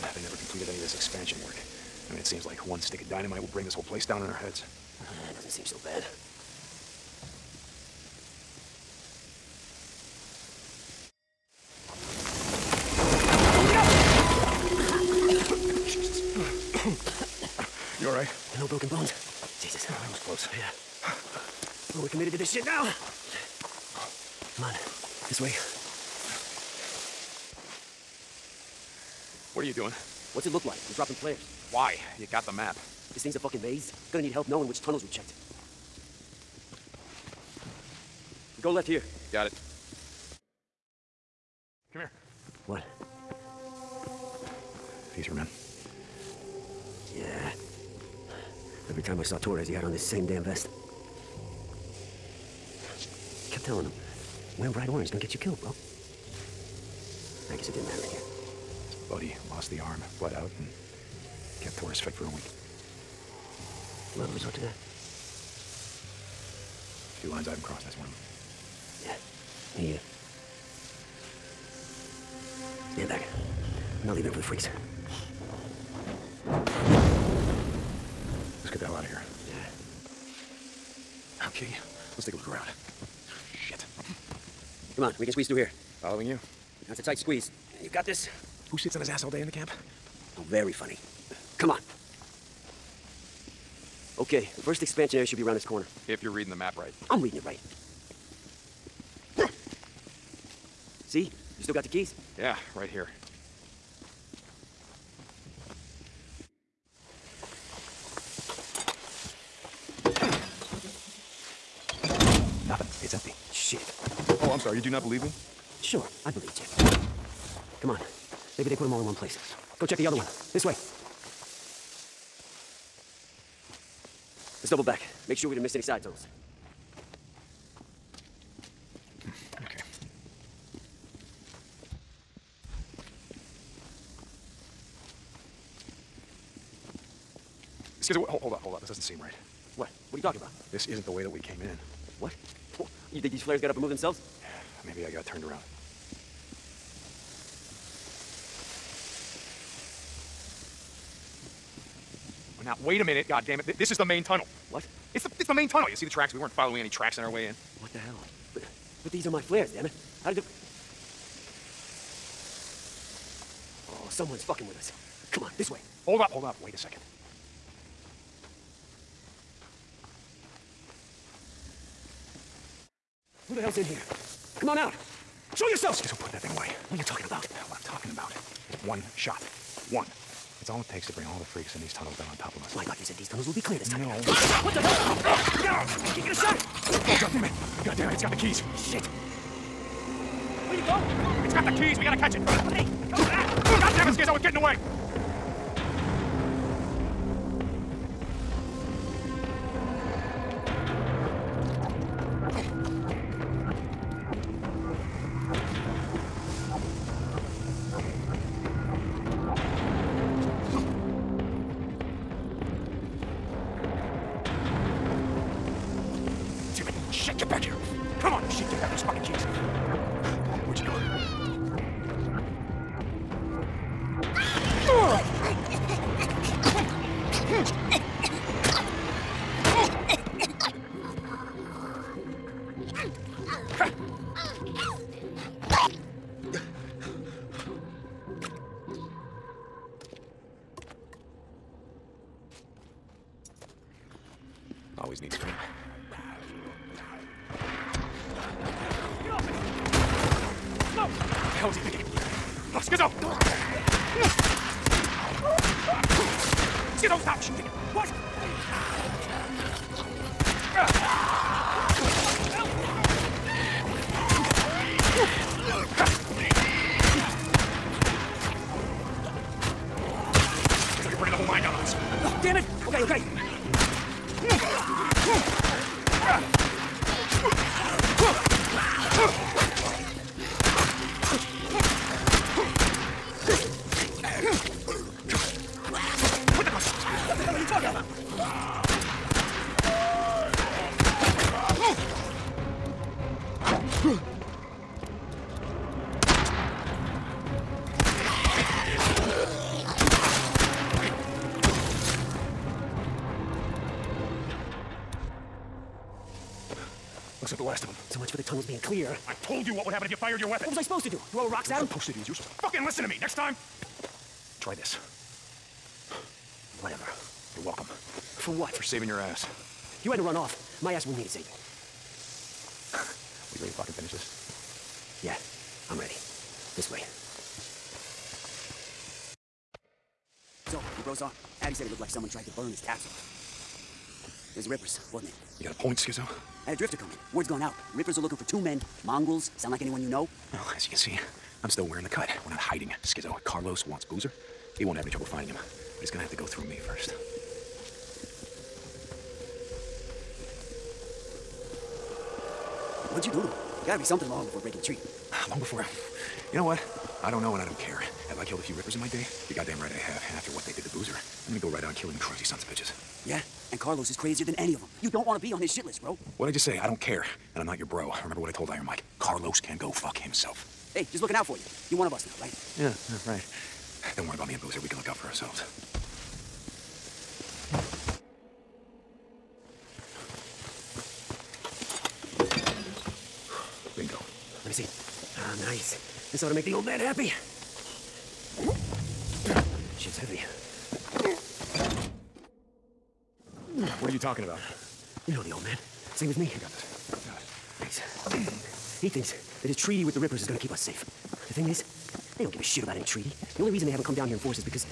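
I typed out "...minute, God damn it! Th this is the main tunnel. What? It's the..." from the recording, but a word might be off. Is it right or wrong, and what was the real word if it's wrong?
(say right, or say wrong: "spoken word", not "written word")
right.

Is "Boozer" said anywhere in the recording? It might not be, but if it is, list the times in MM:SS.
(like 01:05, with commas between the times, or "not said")
05:44, 06:00, 06:14.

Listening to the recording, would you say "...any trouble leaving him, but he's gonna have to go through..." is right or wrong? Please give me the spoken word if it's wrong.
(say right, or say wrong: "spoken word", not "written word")
wrong: "finding", not "leaving".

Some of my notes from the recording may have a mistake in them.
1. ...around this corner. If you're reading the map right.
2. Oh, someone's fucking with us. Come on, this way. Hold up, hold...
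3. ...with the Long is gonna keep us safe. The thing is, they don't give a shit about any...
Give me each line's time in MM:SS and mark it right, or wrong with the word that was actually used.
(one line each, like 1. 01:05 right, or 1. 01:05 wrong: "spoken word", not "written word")
1. 01:35 right
2. 02:43 right
3. 06:40 wrong: "Rippers", not "Long".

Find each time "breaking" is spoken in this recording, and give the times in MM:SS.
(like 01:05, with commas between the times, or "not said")
05:54.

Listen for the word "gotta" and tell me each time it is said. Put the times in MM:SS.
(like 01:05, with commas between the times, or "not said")
03:12, 05:53.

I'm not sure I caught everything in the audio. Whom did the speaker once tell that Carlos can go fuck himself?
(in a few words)
Iron Mike.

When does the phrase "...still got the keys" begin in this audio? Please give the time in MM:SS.
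01:41.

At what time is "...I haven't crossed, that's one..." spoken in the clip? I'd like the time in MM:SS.
01:07.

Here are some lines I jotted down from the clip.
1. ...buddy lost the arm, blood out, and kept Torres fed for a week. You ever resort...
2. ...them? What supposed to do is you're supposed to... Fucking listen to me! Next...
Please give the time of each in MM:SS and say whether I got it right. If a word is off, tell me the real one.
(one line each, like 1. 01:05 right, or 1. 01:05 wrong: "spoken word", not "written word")
1. 00:59 right
2. 05:11 right.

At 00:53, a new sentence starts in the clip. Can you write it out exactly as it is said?
I kept telling him, wearing bright orange is gonna get you killed, bro.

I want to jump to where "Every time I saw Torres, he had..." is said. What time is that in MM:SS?
00:48.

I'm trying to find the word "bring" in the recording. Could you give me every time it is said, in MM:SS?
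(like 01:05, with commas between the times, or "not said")
00:03, 03:01.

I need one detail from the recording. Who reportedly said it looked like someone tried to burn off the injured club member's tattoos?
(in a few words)
Addie.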